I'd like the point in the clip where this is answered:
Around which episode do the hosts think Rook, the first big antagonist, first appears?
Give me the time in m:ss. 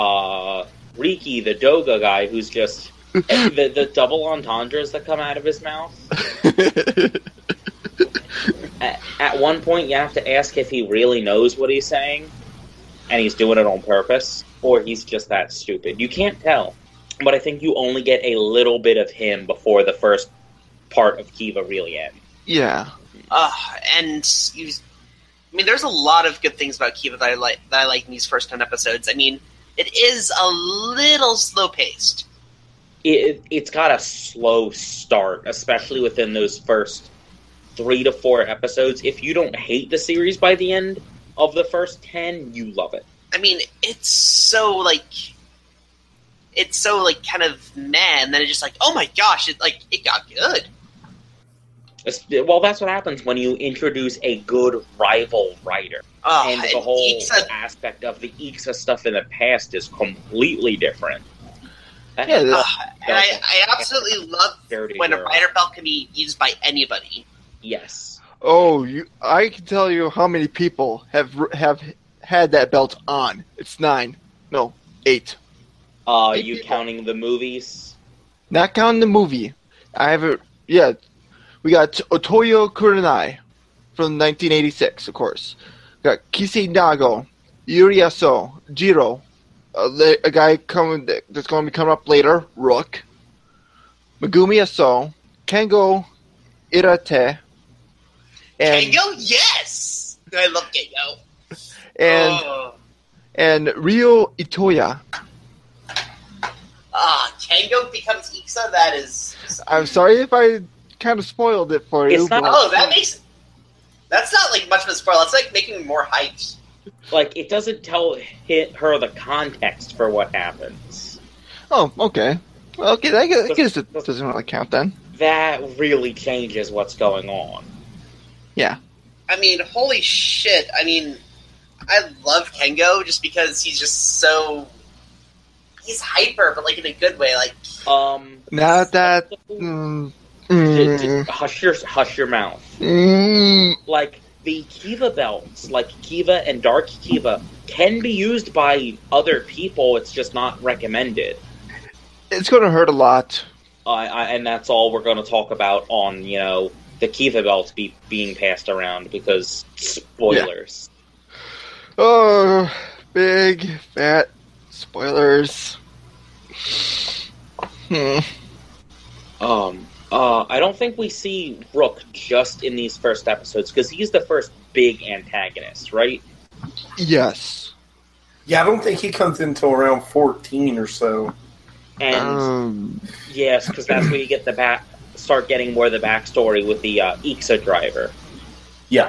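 3:00.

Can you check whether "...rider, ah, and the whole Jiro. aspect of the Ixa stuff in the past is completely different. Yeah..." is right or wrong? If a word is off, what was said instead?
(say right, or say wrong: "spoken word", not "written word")
wrong: "Ixa", not "Jiro".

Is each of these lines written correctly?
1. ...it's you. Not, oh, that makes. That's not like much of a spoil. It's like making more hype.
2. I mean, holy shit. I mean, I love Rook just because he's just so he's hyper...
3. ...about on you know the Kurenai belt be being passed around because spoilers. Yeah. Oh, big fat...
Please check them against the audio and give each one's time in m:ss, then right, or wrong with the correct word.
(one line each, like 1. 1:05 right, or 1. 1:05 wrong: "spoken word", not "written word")
1. 1:52 right
2. 2:09 wrong: "Kengo", not "Rook"
3. 2:35 wrong: "Kiva", not "Kurenai".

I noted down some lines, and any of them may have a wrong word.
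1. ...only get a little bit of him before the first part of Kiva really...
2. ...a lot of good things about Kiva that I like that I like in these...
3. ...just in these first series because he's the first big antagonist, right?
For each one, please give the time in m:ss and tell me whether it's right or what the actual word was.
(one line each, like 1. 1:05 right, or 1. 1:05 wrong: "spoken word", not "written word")
1. 0:17 right
2. 0:25 right
3. 2:52 wrong: "episodes", not "series".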